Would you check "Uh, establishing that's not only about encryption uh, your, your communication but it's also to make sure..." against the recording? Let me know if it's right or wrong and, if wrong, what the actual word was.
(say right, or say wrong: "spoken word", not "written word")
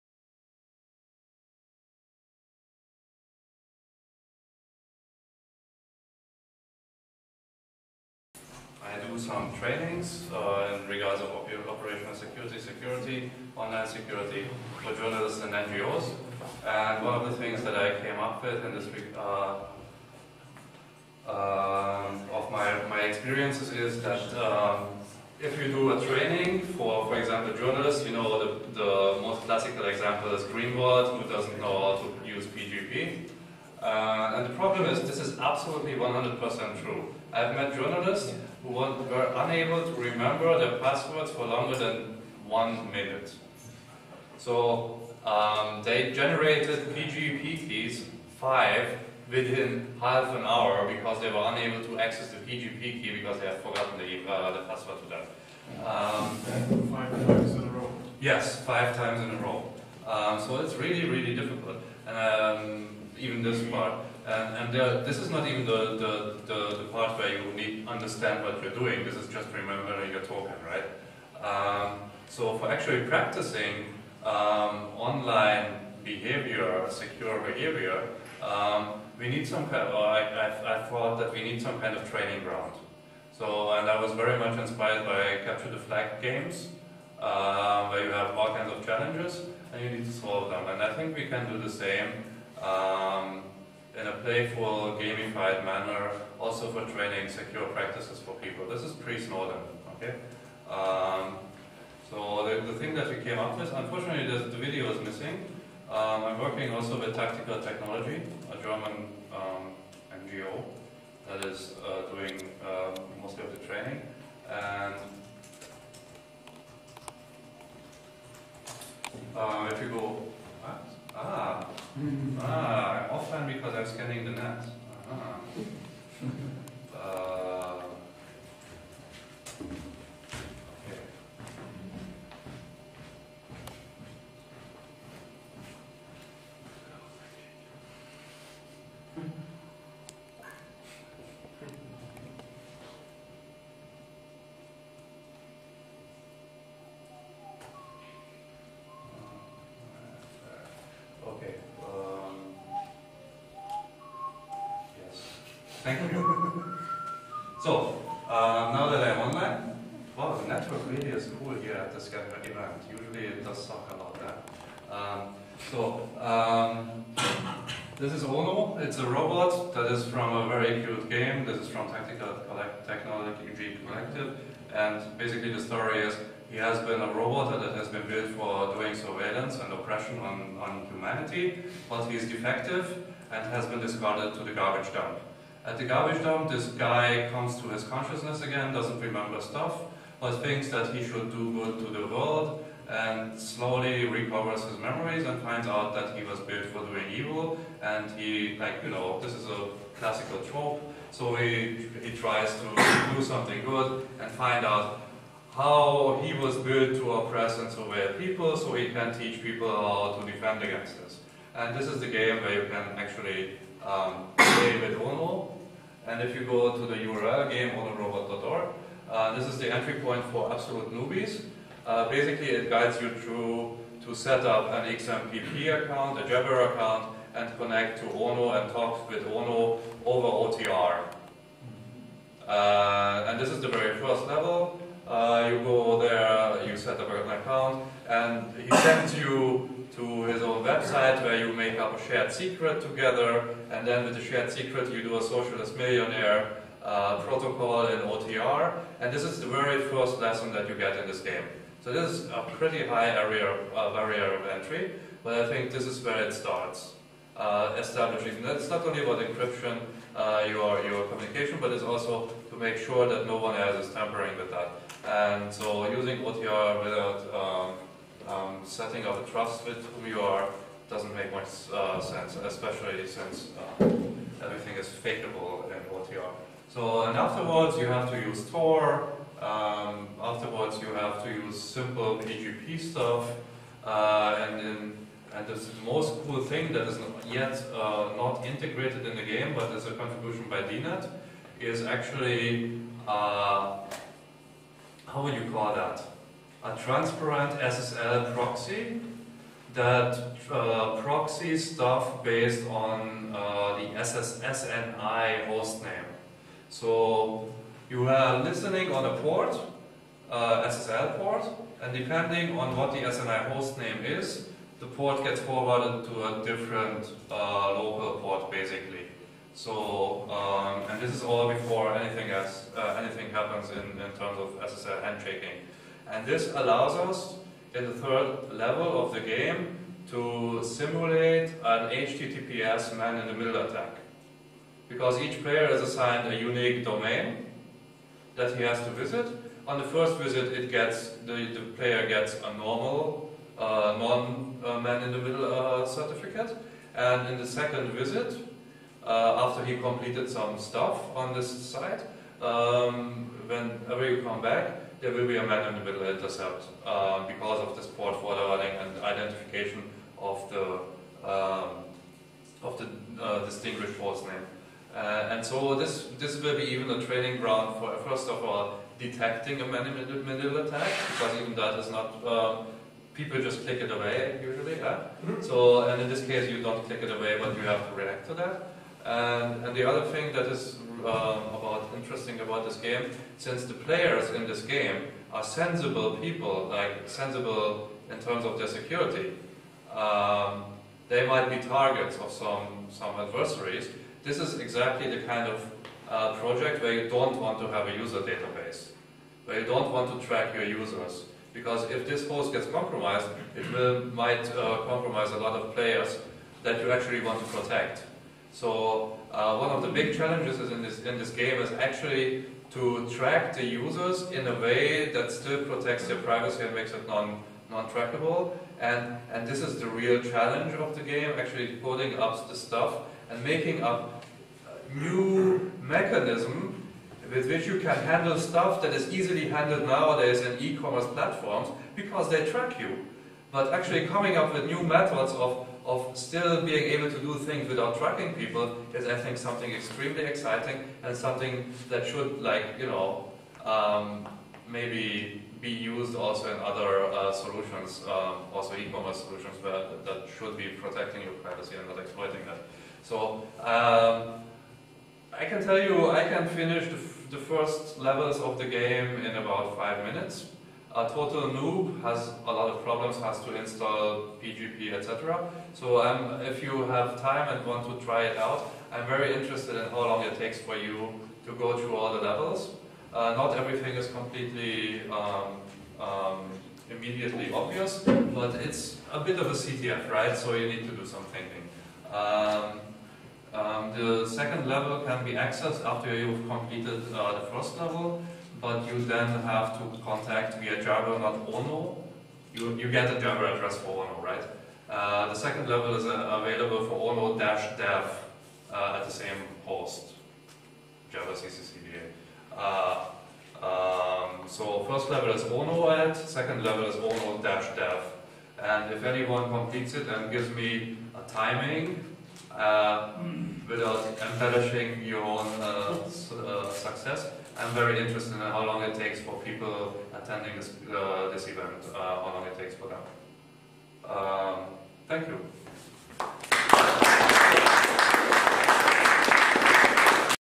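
right.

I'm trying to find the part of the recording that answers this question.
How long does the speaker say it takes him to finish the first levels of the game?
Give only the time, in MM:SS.
07:39.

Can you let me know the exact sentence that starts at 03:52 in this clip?
Uh, and this is the very first level.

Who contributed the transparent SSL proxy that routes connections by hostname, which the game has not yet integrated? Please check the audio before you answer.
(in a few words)
DNet.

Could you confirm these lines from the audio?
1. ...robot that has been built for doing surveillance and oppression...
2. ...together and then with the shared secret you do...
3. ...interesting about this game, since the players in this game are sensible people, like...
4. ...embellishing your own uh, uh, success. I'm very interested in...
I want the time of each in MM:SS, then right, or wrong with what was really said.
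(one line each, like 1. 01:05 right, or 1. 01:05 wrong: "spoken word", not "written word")
1. 02:57 right
2. 04:02 right
3. 06:21 right
4. 08:34 right.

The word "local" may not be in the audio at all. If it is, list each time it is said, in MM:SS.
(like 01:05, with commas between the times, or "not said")
05:17.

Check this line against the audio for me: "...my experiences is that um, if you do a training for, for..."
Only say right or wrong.
right.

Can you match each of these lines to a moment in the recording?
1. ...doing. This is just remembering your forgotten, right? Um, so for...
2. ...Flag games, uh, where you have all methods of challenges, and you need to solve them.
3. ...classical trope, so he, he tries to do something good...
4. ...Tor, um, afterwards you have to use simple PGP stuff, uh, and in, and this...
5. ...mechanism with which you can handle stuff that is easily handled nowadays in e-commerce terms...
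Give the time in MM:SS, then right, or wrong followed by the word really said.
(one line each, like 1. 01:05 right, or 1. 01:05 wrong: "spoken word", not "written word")
1. 01:08 wrong: "token", not "forgotten"
2. 01:25 wrong: "kinds", not "methods"
3. 03:19 right
4. 04:38 right
5. 07:05 wrong: "platforms", not "terms".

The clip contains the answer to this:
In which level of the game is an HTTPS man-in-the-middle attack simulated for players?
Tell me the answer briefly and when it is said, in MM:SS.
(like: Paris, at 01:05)
third level, at 05:27.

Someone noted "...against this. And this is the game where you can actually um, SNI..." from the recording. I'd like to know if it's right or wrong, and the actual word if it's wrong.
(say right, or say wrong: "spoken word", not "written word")
wrong: "David", not "SNI".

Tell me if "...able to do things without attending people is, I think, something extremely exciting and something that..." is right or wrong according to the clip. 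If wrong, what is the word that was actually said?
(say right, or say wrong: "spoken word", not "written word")
wrong: "tracking", not "attending".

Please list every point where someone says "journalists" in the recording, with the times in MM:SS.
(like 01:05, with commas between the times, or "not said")
00:14, 00:27, 00:37.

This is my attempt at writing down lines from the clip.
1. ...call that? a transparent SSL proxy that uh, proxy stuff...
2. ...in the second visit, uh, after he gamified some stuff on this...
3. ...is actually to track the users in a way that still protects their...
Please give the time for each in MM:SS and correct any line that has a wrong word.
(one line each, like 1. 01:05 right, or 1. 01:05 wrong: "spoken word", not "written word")
1. 04:55 right
2. 05:47 wrong: "completed", not "gamified"
3. 06:51 right.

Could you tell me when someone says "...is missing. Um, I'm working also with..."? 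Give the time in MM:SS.
01:44.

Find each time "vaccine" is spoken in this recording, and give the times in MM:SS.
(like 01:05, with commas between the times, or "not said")
not said.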